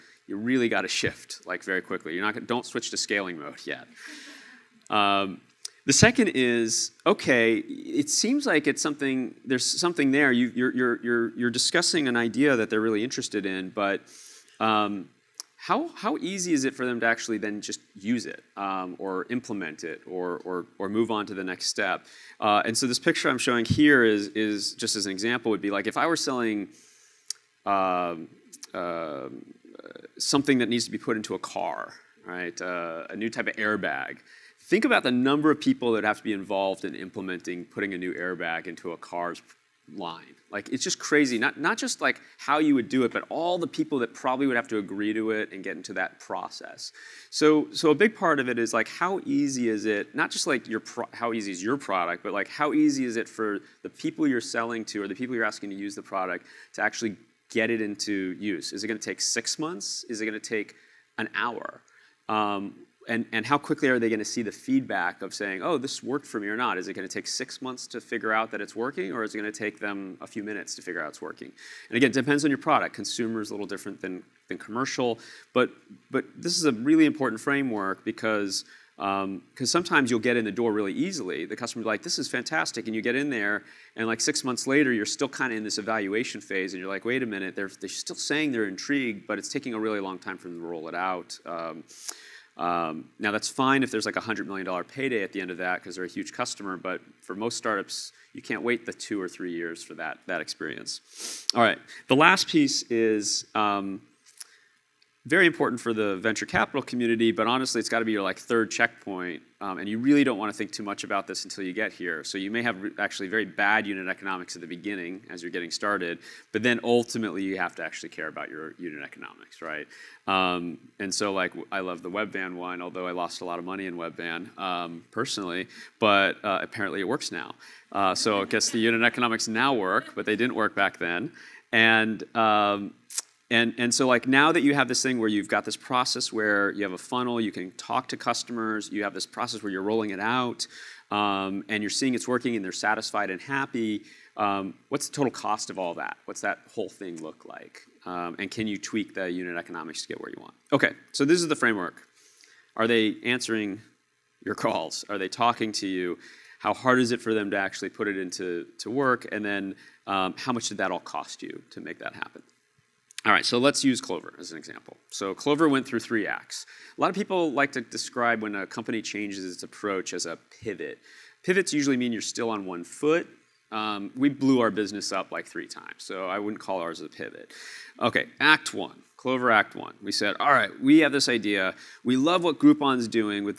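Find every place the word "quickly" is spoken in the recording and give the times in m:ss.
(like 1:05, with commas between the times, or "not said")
0:01, 1:03.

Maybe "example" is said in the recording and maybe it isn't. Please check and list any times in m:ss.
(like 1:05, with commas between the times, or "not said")
0:25, 2:44.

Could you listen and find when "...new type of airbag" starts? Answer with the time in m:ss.
0:33.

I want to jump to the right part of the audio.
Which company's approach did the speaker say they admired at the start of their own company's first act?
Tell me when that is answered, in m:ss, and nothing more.
3:02.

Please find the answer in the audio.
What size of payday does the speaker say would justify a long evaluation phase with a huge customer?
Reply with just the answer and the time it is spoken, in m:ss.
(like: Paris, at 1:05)
$100 million, at 1:34.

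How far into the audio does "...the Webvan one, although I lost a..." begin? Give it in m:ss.
2:02.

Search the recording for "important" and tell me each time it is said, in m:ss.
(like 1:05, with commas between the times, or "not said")
1:17, 1:45.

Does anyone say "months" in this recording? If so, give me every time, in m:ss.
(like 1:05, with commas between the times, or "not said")
0:59, 1:07, 1:24.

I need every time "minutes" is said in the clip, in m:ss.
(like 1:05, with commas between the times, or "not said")
1:10, 1:27.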